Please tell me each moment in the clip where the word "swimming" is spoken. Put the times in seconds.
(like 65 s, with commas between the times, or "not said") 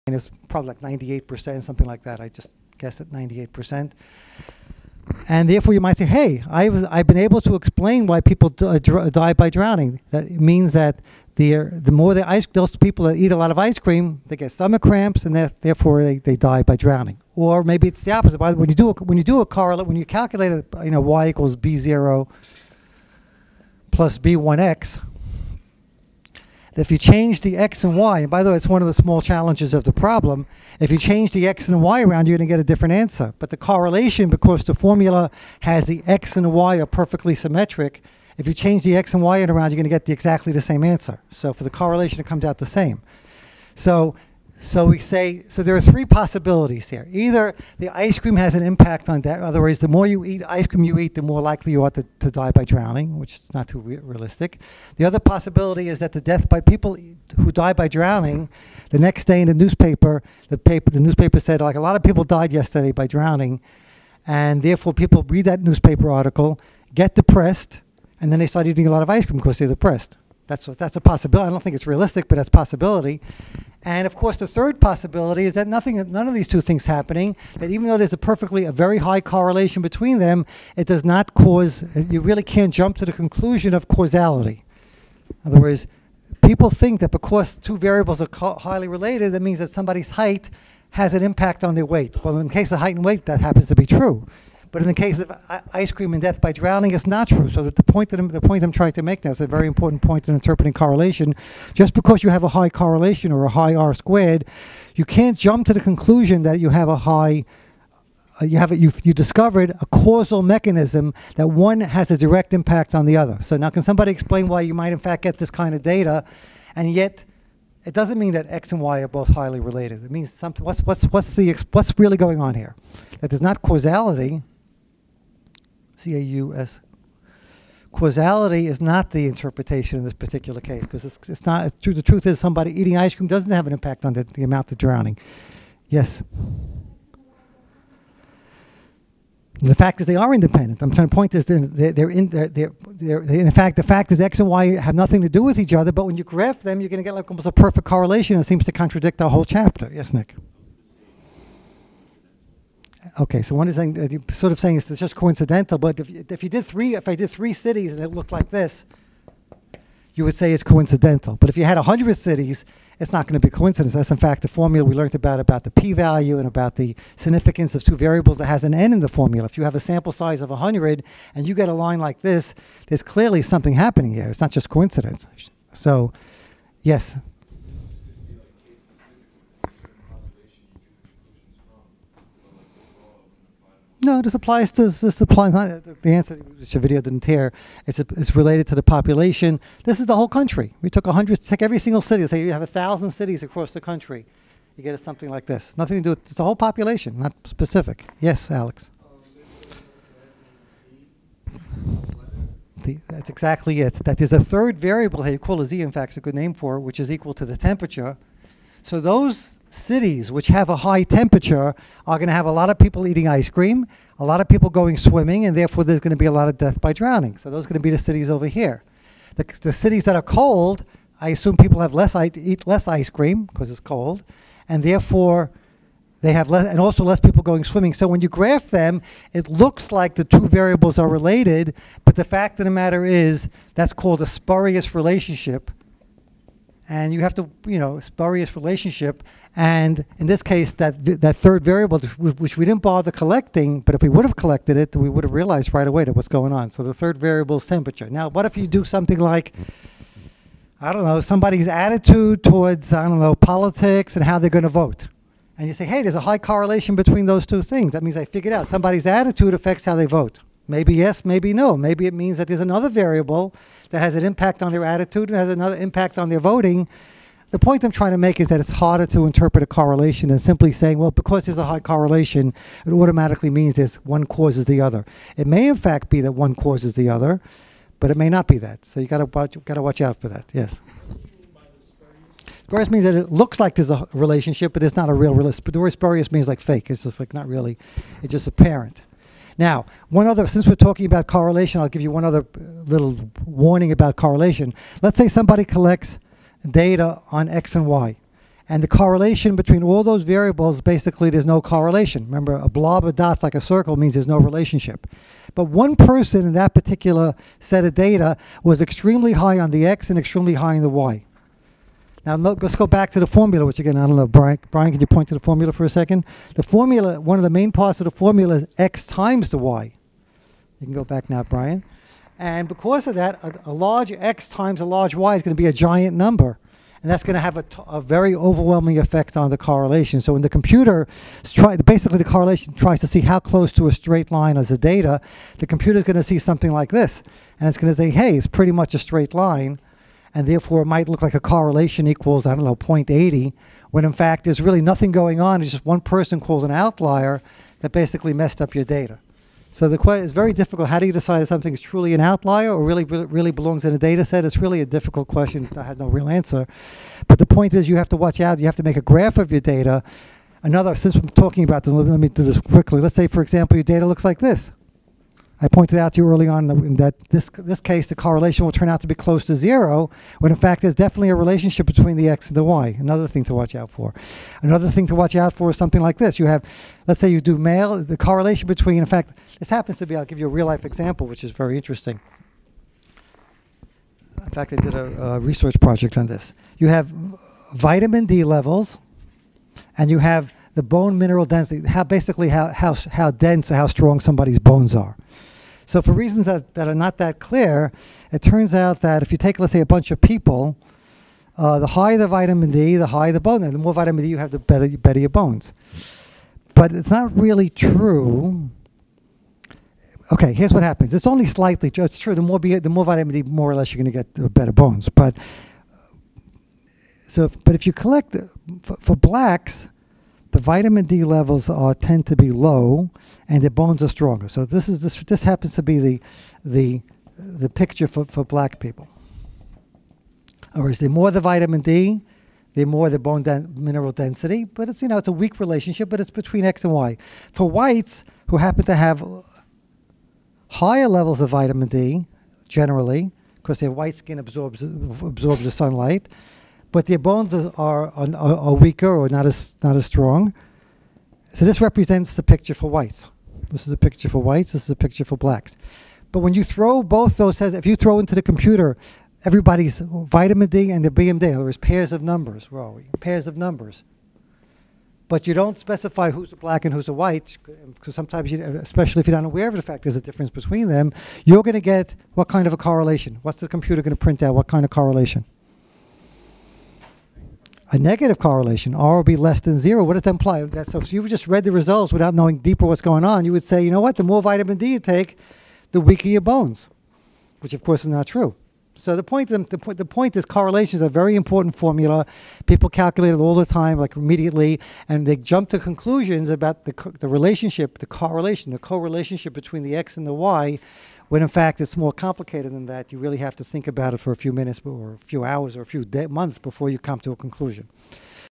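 214 s, 227 s.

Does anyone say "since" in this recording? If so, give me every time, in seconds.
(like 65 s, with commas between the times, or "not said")
290 s, 360 s.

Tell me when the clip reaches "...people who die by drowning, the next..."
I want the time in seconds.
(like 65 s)
56 s.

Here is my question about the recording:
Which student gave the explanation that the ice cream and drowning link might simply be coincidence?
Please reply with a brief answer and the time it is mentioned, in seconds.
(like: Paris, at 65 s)
Nick, at 150 s.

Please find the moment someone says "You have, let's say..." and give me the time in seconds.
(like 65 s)
376 s.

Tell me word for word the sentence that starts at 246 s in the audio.
So the third variable is temperature.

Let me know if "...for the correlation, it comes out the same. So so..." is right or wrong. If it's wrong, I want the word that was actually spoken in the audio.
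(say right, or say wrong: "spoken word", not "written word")
right.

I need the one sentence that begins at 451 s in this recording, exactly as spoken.
So this represents the picture for whites.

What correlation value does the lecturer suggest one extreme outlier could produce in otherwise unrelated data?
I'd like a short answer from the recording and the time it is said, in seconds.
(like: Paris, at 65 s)
0.80, at 342 s.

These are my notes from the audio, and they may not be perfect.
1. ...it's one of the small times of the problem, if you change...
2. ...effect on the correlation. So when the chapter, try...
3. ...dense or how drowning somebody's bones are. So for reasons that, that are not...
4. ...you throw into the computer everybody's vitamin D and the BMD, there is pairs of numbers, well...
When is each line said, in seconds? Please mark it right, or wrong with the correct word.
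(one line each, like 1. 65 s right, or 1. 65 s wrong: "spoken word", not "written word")
1. 28 s wrong: "challenges", not "times"
2. 328 s wrong: "computer", not "chapter"
3. 393 s wrong: "strong", not "drowning"
4. 457 s right.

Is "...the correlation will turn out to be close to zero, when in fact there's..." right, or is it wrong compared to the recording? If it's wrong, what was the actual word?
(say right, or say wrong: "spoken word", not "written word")
right.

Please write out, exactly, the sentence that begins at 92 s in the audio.
Well, in the case of height and weight, that happens to be true.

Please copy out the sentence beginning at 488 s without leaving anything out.
So the point, the, point, the point is correlations are a very important formula.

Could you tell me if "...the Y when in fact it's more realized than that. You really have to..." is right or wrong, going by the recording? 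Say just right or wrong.
wrong.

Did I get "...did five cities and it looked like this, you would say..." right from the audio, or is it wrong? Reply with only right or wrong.
wrong.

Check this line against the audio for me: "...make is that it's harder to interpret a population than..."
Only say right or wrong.
wrong.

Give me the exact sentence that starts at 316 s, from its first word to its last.
The formula, one of the main parts of the formula is x times the y.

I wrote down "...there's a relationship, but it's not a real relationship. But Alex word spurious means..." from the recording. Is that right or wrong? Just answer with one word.
wrong.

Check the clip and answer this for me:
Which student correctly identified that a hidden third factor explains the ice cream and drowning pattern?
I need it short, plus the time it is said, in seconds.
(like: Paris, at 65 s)
Alex, at 198 s.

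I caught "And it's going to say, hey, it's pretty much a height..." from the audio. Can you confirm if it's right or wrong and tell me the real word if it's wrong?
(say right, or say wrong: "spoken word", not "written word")
wrong: "straight", not "height".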